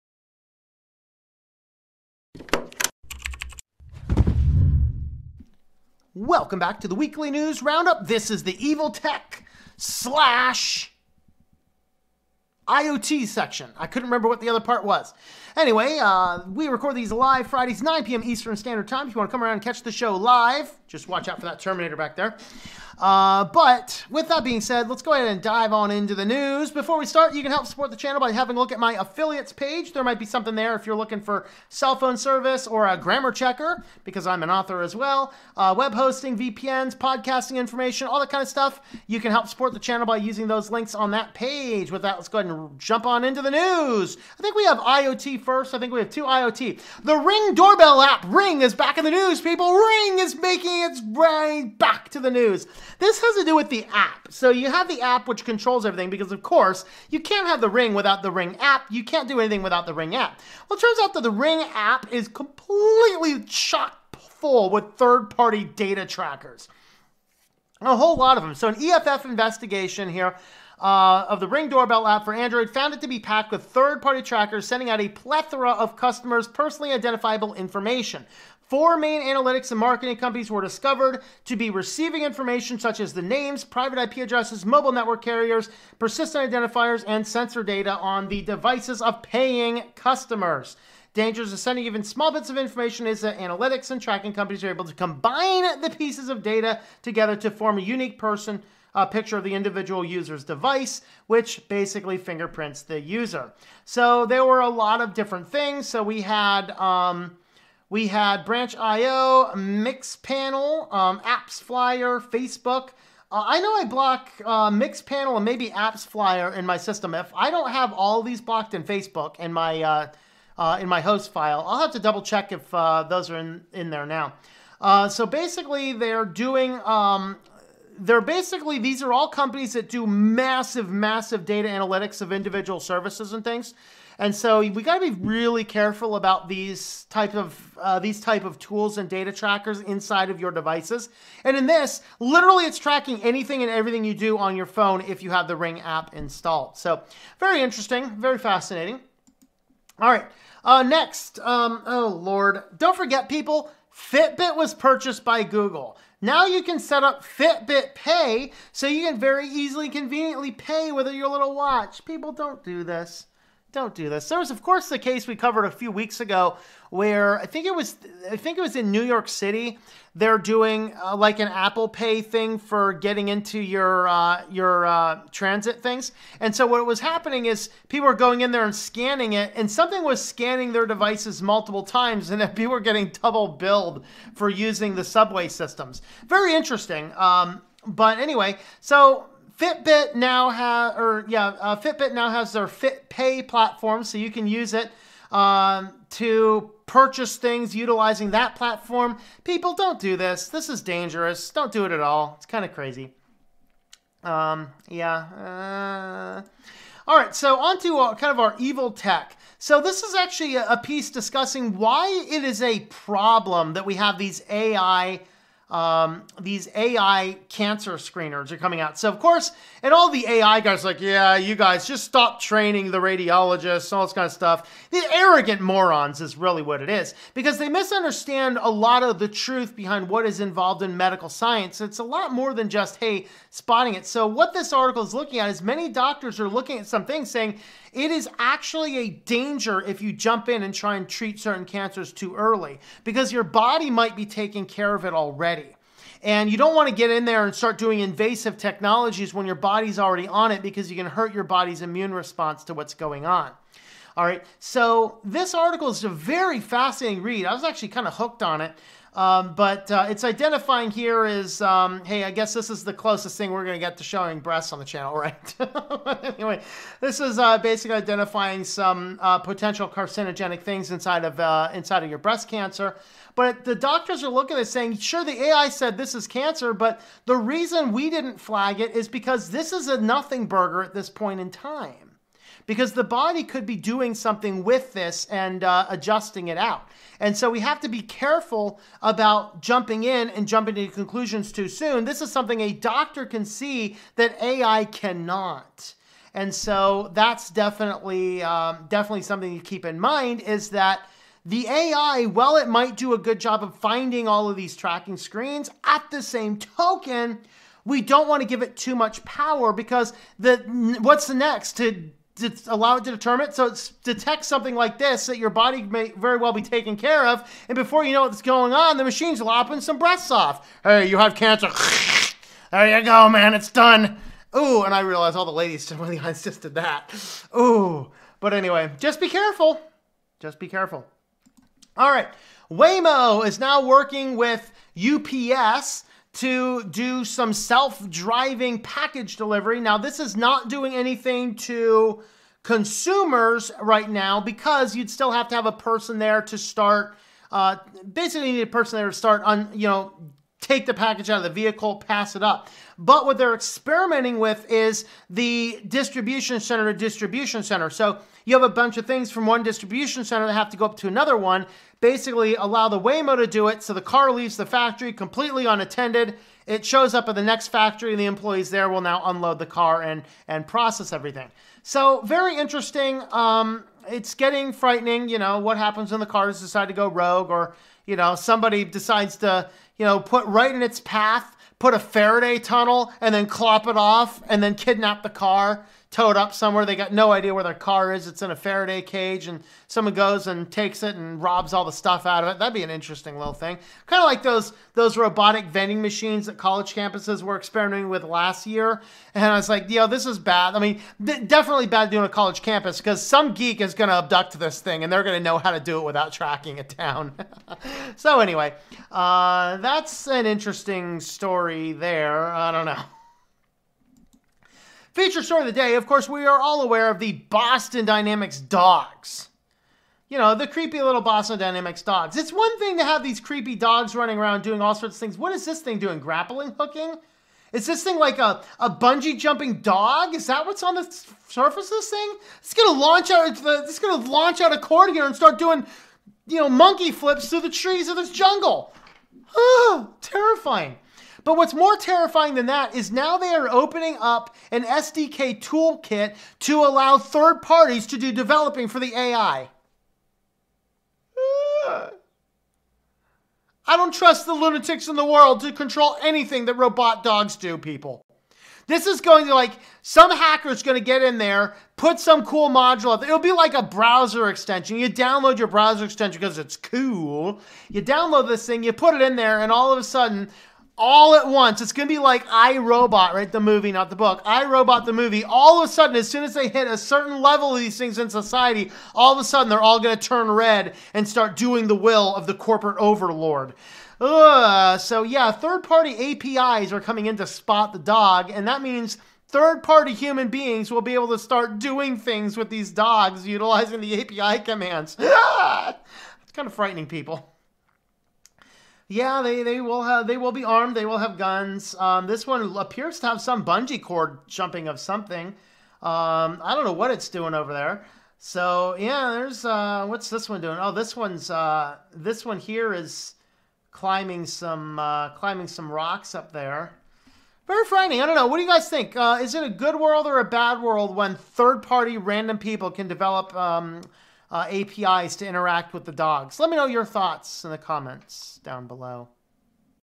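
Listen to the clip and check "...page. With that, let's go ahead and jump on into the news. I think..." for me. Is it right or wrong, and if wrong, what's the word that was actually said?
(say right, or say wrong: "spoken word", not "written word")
right.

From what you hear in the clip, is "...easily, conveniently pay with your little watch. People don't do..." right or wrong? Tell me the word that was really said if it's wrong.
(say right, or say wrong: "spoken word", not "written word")
right.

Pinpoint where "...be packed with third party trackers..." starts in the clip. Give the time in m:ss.
1:13.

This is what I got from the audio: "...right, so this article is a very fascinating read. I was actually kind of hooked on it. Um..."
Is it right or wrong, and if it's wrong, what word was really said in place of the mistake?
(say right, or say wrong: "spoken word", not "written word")
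right.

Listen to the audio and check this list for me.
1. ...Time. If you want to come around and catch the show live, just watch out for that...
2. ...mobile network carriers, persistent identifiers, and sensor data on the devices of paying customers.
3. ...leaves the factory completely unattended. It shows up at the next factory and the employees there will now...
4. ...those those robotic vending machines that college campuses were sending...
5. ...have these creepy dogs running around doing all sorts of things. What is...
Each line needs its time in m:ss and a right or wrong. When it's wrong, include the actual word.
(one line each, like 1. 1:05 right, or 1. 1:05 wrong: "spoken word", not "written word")
1. 0:18 right
2. 1:24 right
3. 6:04 right
4. 6:34 wrong: "experimenting", not "sending"
5. 7:03 right.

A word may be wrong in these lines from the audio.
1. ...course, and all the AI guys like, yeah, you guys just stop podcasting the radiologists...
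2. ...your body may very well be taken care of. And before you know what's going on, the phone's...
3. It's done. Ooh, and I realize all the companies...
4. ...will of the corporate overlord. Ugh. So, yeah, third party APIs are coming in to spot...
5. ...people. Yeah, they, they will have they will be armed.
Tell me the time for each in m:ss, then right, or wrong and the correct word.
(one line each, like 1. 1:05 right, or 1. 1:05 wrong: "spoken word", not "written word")
1. 3:39 wrong: "training", not "podcasting"
2. 5:15 wrong: "machine", not "phone"
3. 5:23 wrong: "ladies", not "companies"
4. 8:01 right
5. 8:17 right.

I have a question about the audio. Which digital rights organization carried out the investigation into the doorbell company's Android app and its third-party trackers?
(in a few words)
EFF.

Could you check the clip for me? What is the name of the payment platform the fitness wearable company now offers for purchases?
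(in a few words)
FitPay.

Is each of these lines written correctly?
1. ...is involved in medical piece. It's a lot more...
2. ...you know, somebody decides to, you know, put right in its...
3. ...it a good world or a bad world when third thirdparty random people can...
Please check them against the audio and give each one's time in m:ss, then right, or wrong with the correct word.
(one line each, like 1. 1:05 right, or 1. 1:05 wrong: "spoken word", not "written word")
1. 3:50 wrong: "science", not "piece"
2. 6:18 right
3. 8:39 wrong: "party", not "thirdparty".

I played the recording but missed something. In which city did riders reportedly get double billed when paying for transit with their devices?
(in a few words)
New York City.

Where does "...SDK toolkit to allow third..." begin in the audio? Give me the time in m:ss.
7:24.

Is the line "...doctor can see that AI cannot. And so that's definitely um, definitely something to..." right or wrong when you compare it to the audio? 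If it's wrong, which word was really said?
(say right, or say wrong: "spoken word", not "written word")
right.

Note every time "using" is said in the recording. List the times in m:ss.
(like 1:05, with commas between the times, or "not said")
0:40, 3:04.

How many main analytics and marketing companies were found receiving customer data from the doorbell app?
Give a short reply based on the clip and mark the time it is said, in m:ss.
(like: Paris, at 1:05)
4, at 1:18.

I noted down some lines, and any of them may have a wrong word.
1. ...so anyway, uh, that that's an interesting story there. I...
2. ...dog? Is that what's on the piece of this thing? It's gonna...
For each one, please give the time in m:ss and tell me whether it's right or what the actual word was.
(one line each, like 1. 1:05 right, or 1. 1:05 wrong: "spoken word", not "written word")
1. 6:48 right
2. 7:09 wrong: "surface", not "piece".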